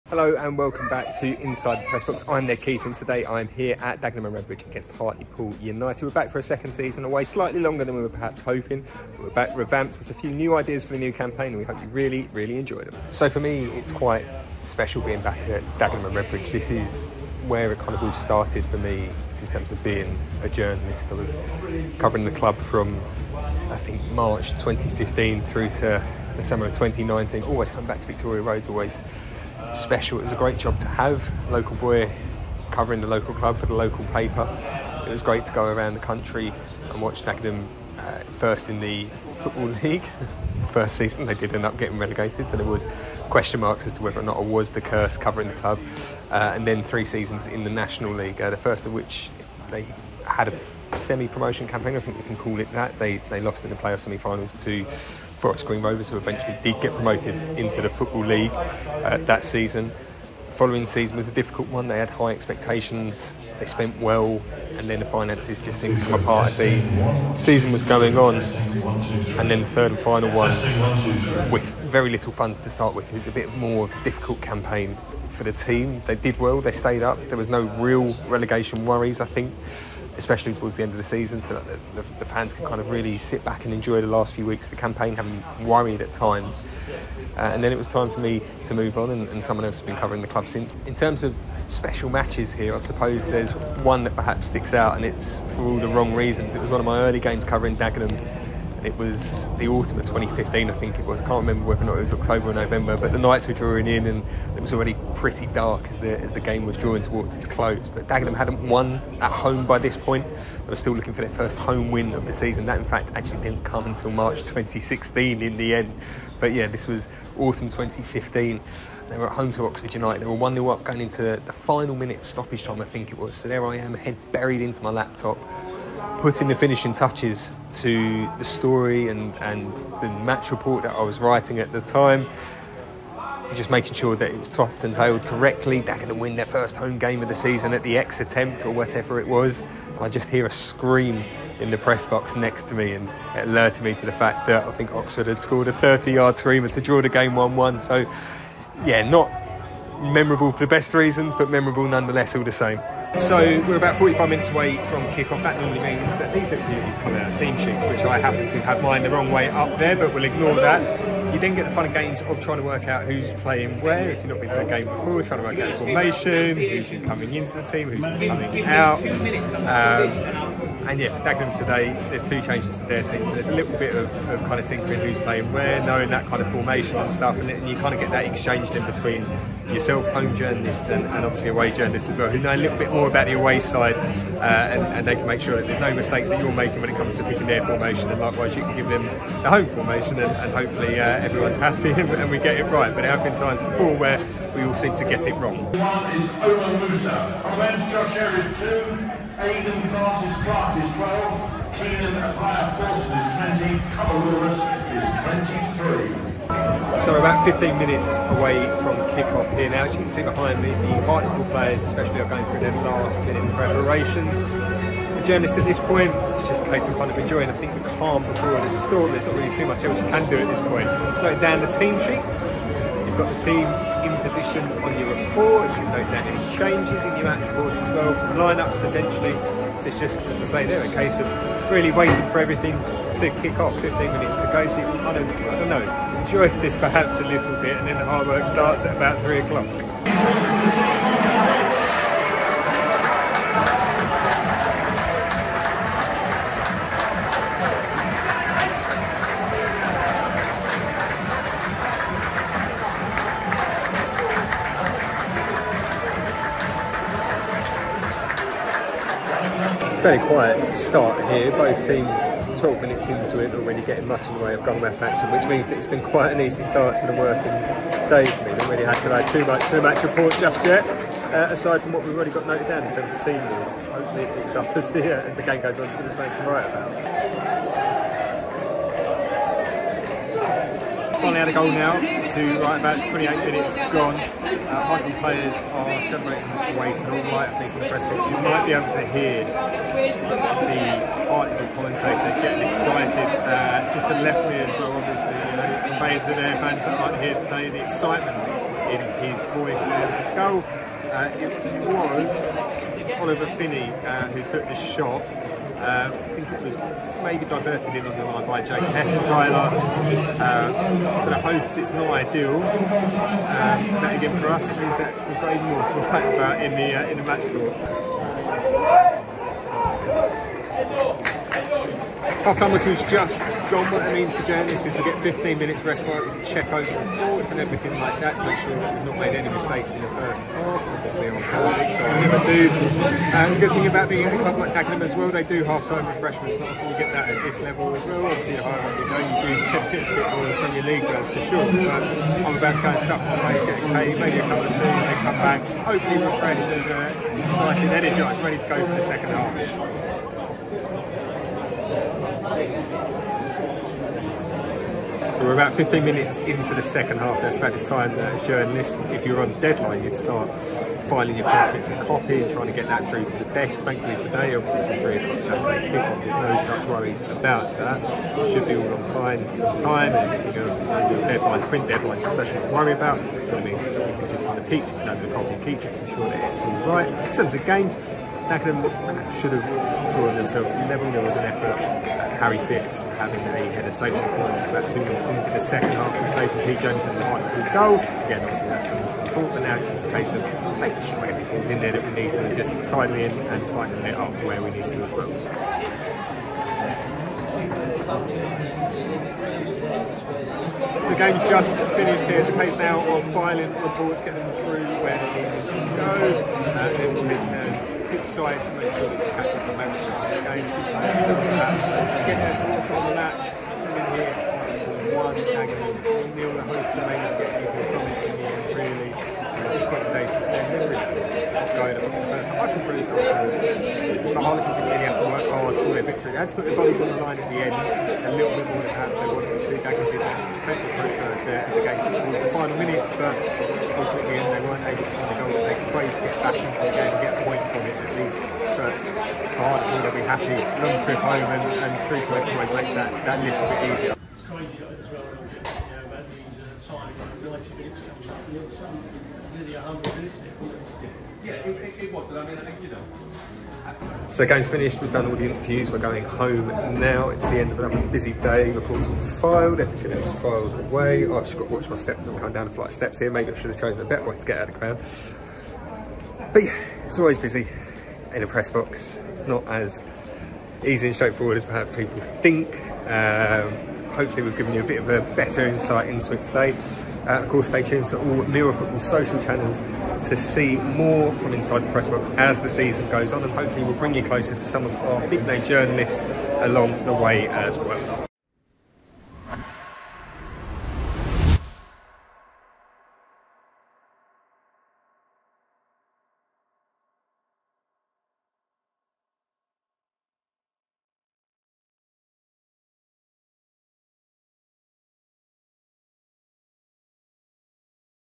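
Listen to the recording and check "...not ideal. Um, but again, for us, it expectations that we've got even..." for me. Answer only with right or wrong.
wrong.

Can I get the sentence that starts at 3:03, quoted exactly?
Uh, and, and, they can make sure that there's no mistakes that you're making when it comes to picking their formation.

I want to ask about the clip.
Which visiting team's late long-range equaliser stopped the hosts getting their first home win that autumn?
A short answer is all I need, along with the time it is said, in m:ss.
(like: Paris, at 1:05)
Oxford United, at 1:59.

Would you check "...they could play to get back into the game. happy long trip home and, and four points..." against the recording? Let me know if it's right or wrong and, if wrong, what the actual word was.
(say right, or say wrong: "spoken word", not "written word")
wrong: "three", not "four".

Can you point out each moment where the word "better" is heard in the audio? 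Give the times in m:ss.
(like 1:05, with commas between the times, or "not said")
7:44, 7:55.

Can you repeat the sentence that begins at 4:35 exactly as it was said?
It's going to say to write about.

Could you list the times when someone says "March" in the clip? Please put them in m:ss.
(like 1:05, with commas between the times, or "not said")
0:24, 1:54.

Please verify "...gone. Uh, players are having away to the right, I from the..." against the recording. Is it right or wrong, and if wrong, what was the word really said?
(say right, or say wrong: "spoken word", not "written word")
wrong: "separating", not "having".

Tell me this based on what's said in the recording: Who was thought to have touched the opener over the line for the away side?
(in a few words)
Jake Hessenthaler.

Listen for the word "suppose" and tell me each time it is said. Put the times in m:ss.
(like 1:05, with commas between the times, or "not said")
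1:32.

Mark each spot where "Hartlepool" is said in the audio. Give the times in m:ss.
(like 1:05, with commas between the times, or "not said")
0:04, 3:31.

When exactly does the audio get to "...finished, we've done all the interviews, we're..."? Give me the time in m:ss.
7:34.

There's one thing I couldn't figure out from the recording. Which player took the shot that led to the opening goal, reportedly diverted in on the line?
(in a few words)
Oliver Finney.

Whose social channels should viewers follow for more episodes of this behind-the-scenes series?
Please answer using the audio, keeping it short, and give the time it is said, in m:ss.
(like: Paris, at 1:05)
Mirror Football, at 7:58.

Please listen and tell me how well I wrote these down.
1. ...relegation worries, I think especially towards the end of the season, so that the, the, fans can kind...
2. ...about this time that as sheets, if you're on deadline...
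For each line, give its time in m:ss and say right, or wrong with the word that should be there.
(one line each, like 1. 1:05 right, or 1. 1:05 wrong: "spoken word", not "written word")
1. 1:18 right
2. 5:57 wrong: "journalists", not "sheets".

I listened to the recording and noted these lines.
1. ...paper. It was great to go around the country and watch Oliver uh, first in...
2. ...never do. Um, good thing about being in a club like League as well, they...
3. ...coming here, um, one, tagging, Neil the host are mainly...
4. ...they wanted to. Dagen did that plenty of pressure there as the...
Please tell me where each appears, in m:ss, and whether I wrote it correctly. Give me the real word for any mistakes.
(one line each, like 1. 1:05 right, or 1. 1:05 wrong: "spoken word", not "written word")
1. 0:34 wrong: "Dagenham", not "Oliver"
2. 5:32 wrong: "Dagenham", not "League"
3. 6:53 right
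4. 7:09 right.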